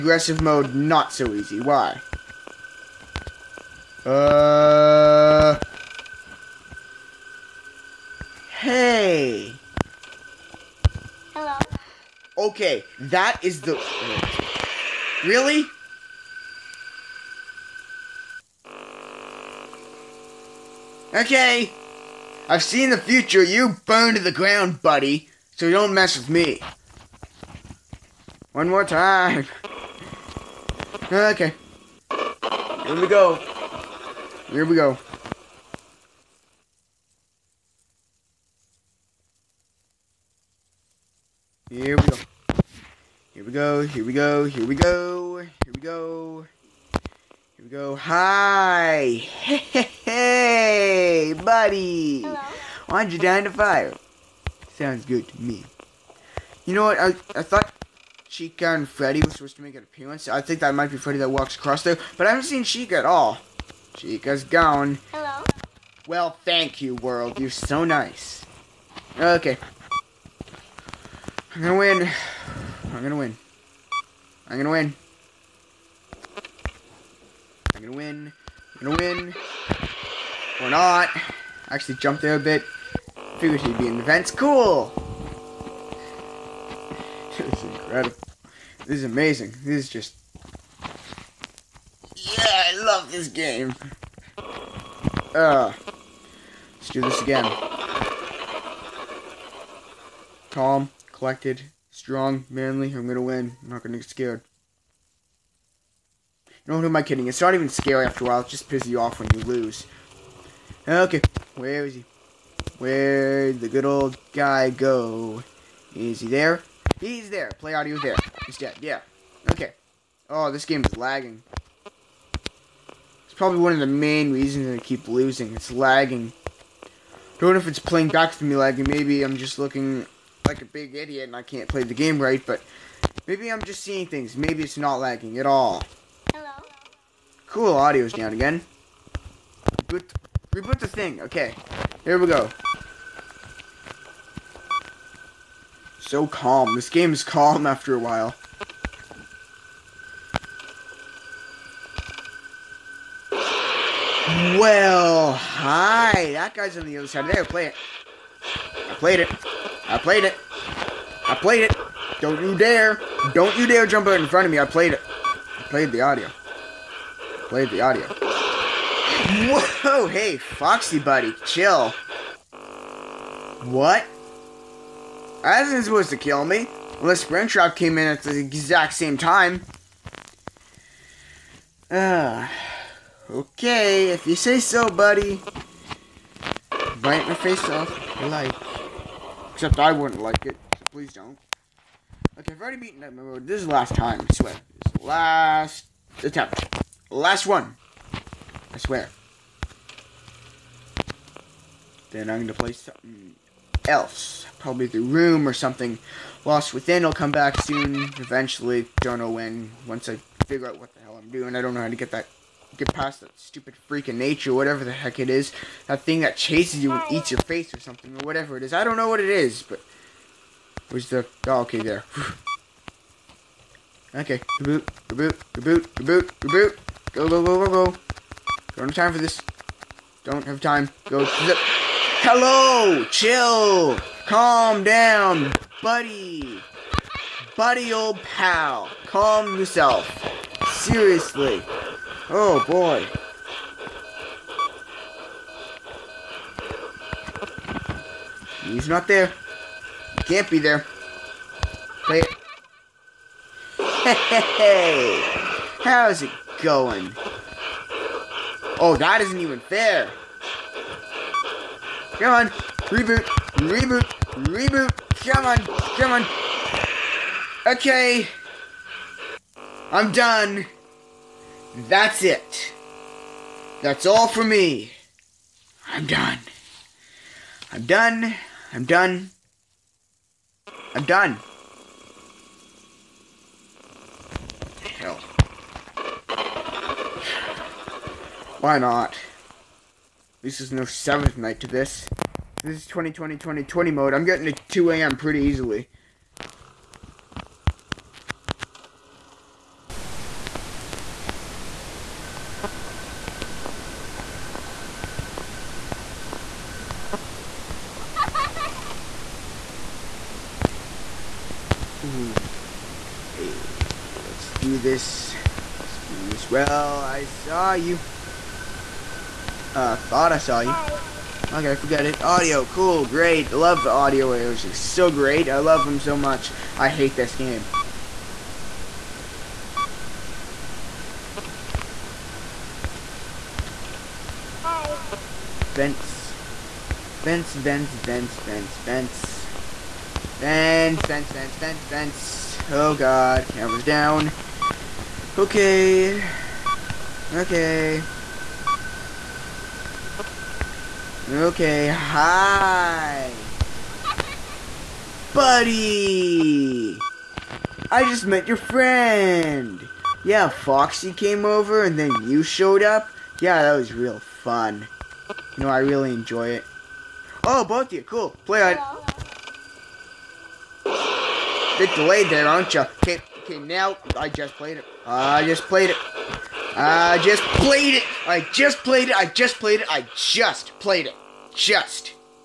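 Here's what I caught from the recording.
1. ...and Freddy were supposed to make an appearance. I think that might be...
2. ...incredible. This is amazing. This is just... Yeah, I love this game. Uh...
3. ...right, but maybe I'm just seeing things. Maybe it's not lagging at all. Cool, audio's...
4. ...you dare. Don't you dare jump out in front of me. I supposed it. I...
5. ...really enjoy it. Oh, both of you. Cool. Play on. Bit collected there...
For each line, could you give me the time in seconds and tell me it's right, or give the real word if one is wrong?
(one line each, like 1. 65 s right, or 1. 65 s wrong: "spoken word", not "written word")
1. 58 s right
2. 87 s right
3. 132 s right
4. 162 s wrong: "played", not "supposed"
5. 365 s wrong: "delayed", not "collected".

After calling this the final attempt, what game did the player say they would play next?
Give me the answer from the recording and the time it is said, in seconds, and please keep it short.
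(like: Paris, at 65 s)
The Room, at 204 s.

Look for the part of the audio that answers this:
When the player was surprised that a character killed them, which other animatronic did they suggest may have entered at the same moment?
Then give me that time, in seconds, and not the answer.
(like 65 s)
177 s.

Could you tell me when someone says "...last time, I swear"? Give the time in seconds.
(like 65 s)
193 s.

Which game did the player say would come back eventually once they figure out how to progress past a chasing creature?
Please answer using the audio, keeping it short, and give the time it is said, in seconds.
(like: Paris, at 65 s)
Lost Within, at 206 s.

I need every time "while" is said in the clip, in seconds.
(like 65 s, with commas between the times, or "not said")
108 s, 147 s.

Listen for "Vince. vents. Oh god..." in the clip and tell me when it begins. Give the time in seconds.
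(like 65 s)
341 s.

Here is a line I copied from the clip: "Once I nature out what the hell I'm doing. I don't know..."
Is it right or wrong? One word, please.
wrong.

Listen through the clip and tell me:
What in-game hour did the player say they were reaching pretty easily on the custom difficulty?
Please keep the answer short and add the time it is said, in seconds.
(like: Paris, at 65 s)
2 a.m., at 294 s.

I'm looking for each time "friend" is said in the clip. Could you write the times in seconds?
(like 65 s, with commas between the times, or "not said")
358 s.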